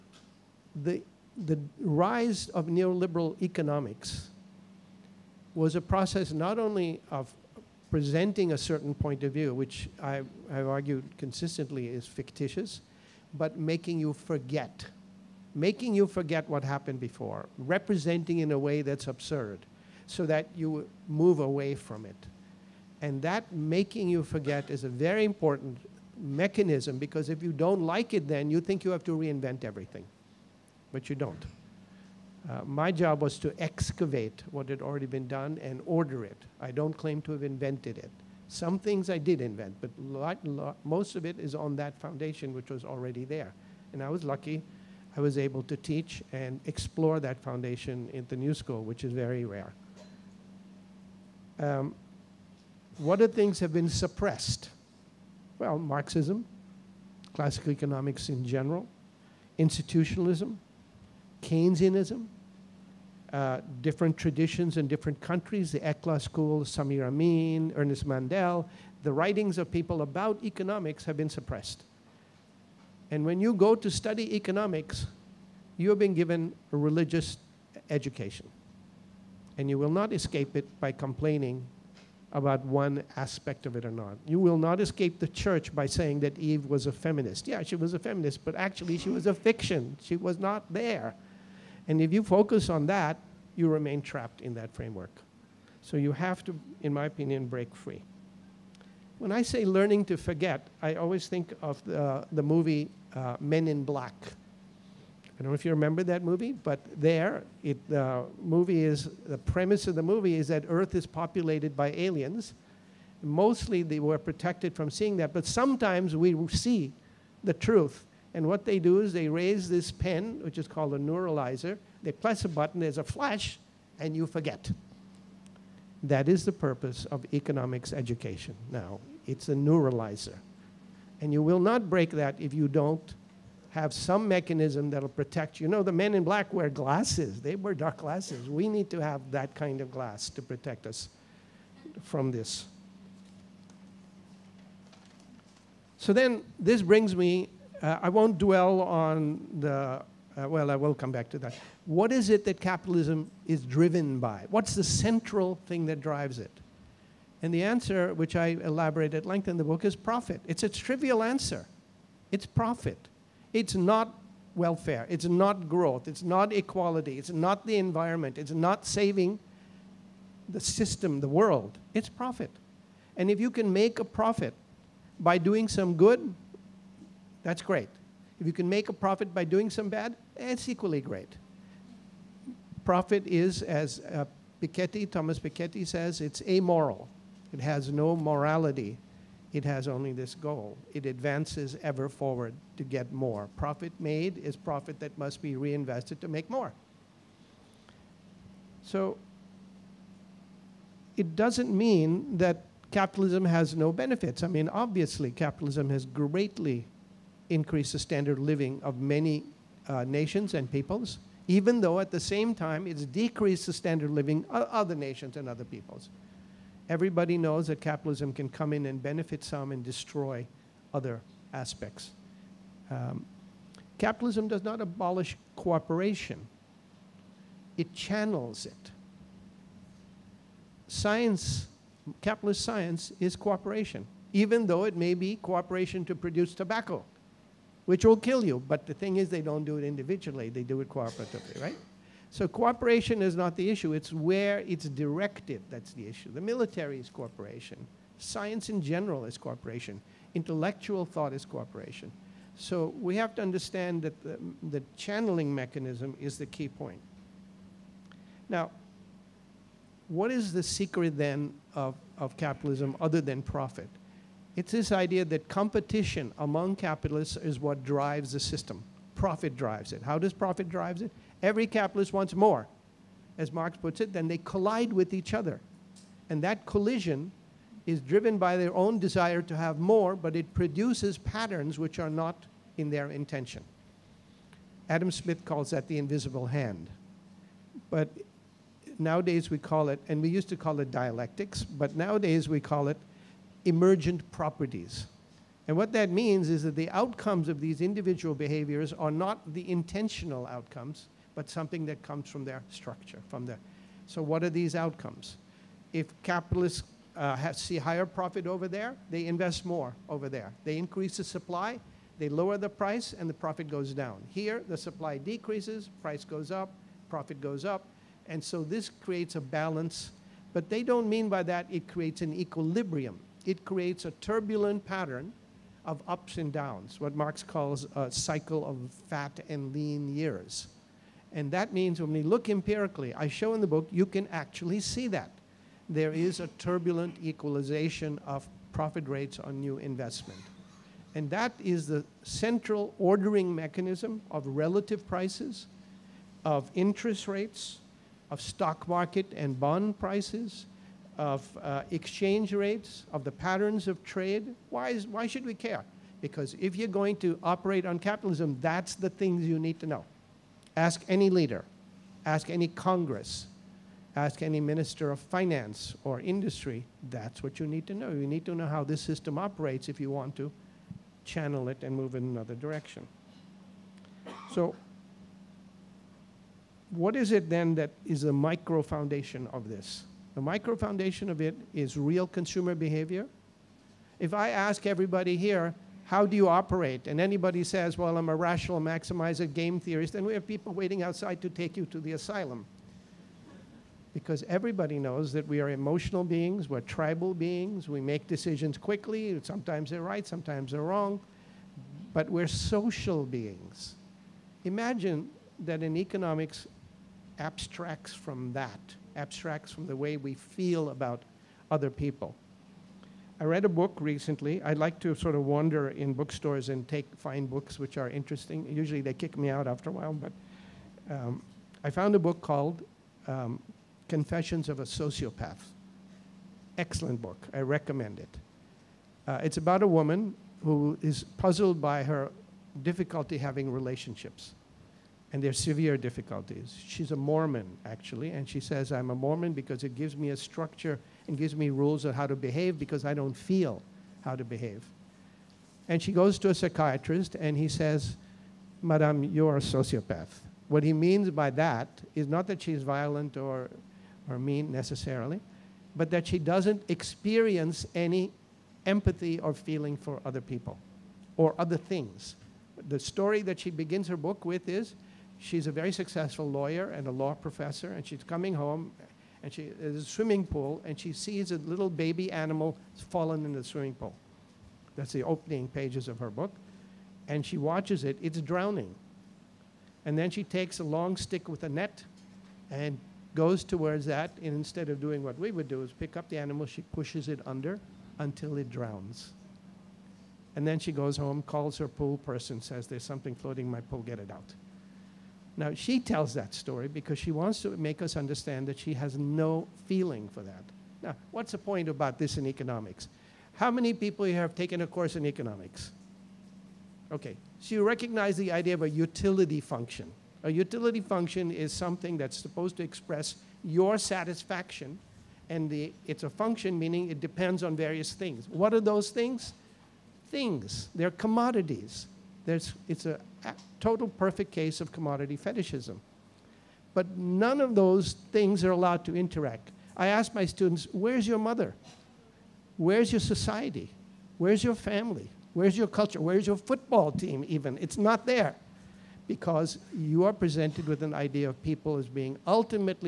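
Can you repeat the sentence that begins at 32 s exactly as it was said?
Uh, my job was to excavate what had already been done and order it.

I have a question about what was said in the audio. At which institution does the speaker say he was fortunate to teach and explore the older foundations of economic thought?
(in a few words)
The New School.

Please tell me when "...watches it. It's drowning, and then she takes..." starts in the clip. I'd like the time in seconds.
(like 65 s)
477 s.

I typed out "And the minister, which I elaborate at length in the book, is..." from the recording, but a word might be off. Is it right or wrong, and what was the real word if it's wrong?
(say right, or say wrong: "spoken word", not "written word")
wrong: "answer", not "minister".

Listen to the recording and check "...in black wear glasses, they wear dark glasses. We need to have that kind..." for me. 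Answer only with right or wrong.
right.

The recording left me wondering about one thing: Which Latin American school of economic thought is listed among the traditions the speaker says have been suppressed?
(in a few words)
ECLA school.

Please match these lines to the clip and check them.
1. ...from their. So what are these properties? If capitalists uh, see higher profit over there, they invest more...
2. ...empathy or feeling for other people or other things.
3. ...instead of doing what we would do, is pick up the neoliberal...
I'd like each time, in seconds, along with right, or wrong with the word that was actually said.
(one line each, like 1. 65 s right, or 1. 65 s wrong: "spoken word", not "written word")
1. 303 s wrong: "outcomes", not "properties"
2. 458 s right
3. 484 s wrong: "animal", not "neoliberal".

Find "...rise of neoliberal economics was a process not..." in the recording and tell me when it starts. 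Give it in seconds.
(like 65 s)
1 s.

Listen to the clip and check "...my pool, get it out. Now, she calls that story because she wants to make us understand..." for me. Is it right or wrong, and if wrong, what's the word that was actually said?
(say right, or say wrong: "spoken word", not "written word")
wrong: "tells", not "calls".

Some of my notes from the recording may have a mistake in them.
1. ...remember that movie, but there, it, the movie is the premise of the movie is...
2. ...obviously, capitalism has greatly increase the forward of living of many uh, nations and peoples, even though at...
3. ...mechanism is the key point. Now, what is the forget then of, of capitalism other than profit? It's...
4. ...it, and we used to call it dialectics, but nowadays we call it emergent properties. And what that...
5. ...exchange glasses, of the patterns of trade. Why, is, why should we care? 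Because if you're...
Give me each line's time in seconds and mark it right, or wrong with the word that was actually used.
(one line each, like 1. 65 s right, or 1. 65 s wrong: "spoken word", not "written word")
1. 105 s right
2. 204 s wrong: "standard", not "forward"
3. 255 s wrong: "secret", not "forget"
4. 289 s right
5. 351 s wrong: "rates", not "glasses".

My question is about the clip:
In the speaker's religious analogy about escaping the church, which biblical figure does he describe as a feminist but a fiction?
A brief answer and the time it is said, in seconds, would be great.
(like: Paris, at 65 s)
Eve, at 86 s.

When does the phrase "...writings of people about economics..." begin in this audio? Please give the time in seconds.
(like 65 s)
69 s.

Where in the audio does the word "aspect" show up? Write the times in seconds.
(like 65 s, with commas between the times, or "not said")
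83 s, 221 s.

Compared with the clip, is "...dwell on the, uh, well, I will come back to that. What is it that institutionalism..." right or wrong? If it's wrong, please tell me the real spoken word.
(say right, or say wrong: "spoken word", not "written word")
wrong: "capitalism", not "institutionalism".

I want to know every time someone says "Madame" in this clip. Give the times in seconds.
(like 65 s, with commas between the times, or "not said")
448 s.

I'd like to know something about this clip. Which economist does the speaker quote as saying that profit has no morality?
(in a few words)
Thomas Piketty.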